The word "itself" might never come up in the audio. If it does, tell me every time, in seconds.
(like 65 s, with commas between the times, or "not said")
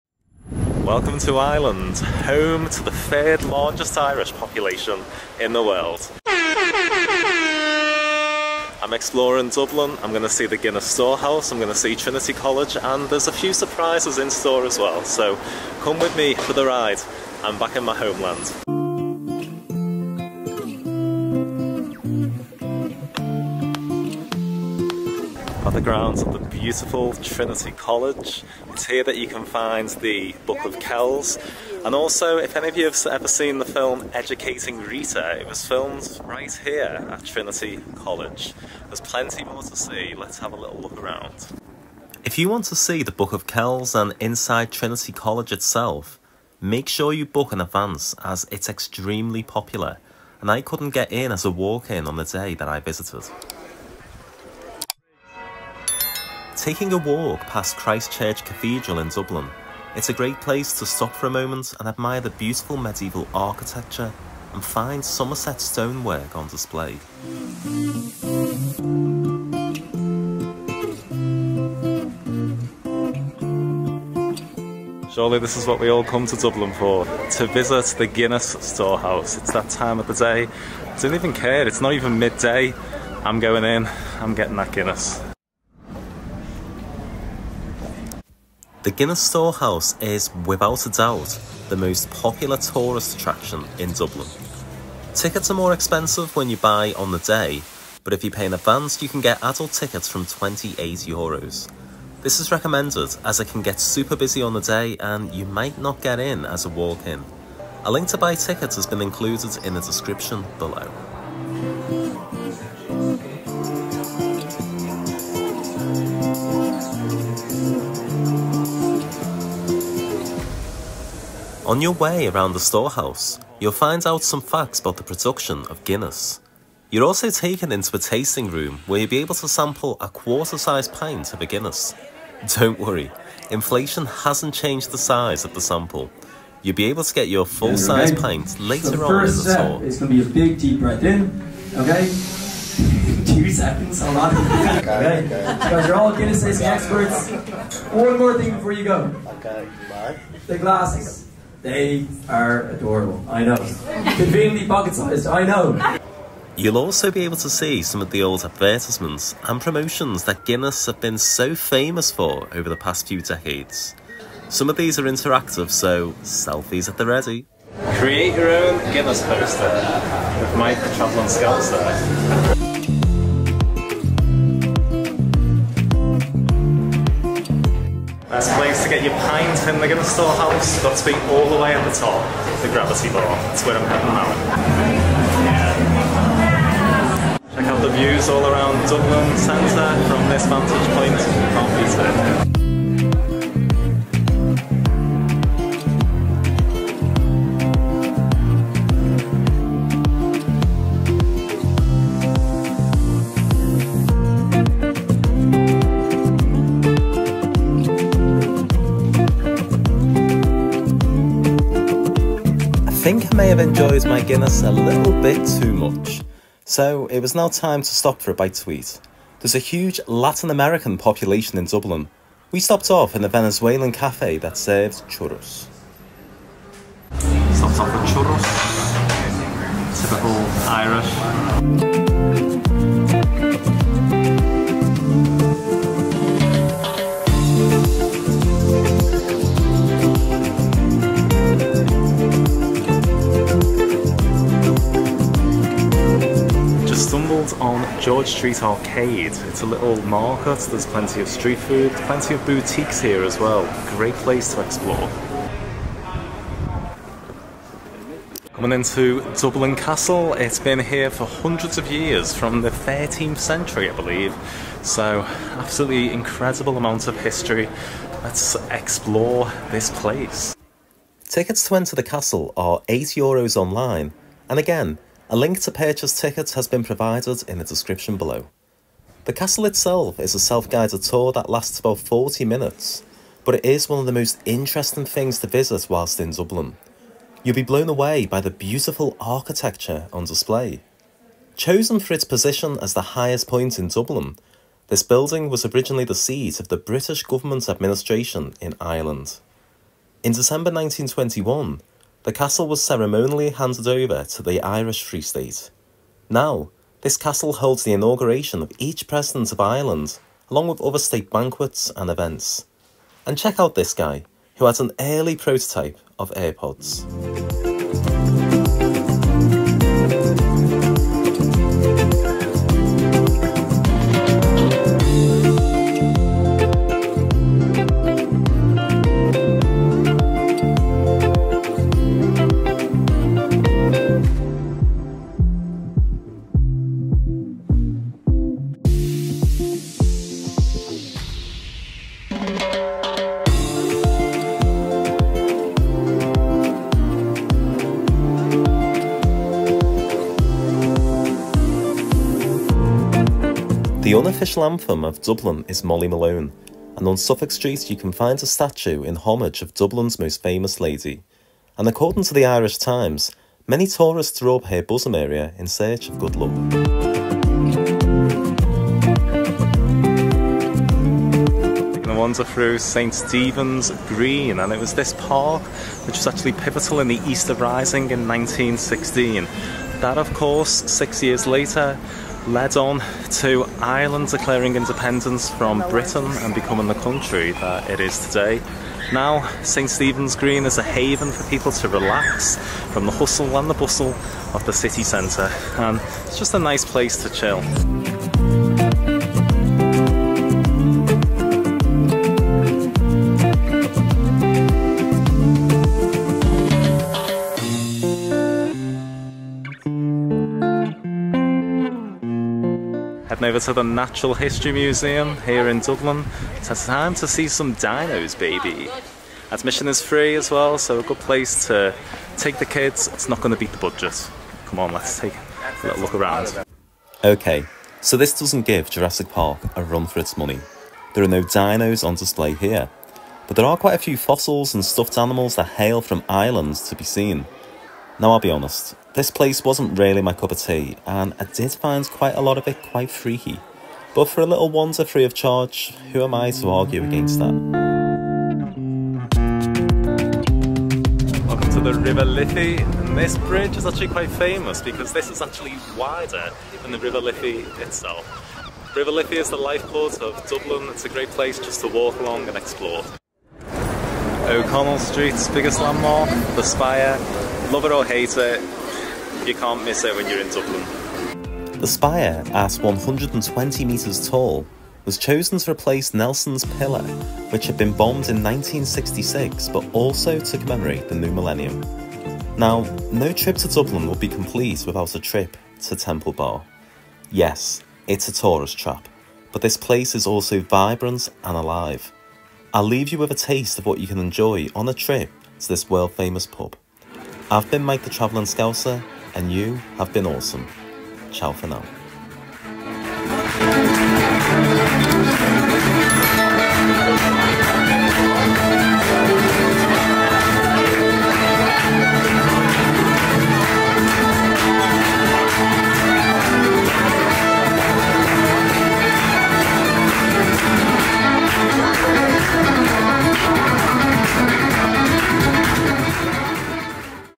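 45 s, 279 s, 457 s.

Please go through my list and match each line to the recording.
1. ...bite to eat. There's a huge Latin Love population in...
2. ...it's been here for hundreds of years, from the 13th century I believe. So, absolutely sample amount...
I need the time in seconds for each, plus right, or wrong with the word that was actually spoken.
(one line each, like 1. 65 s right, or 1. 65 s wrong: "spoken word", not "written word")
1. 218 s wrong: "American", not "Love"
2. 260 s wrong: "incredible", not "sample".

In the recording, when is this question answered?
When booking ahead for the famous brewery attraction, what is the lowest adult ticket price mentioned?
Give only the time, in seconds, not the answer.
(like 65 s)
100 s.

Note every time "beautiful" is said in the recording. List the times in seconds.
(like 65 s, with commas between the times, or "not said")
26 s, 62 s, 288 s.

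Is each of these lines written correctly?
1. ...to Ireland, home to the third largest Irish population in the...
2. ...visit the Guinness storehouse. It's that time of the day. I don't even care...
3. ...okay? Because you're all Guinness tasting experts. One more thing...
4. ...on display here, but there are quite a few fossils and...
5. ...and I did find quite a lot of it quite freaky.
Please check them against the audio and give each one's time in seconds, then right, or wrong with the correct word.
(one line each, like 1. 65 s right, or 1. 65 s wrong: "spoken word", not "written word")
1. 1 s right
2. 77 s right
3. 144 s right
4. 432 s right
5. 441 s right.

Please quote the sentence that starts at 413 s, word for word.
Heading over to the Natural History Museum here in Dublin.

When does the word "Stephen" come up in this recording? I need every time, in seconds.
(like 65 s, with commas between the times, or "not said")
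373 s, 389 s.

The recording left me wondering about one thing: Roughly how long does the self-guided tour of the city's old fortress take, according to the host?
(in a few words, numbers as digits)
40 minutes.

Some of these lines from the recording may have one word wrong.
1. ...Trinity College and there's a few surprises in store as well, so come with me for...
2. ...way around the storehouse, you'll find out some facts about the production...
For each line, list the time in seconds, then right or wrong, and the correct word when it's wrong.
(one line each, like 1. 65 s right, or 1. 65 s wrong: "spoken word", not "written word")
1. 11 s right
2. 121 s right.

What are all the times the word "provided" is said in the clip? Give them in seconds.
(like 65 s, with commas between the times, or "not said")
276 s.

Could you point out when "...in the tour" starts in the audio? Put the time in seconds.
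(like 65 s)
139 s.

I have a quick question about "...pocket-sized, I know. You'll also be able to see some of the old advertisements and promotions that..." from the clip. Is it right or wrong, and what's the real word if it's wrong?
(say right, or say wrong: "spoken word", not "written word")
right.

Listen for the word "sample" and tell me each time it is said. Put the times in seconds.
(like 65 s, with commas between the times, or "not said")
129 s, 135 s.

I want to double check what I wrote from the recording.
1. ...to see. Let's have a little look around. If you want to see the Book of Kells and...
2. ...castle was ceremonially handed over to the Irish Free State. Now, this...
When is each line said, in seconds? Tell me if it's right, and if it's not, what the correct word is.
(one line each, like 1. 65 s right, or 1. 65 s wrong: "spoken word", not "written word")
1. 39 s right
2. 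302 s right.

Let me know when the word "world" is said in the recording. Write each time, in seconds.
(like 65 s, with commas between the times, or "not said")
5 s, 495 s.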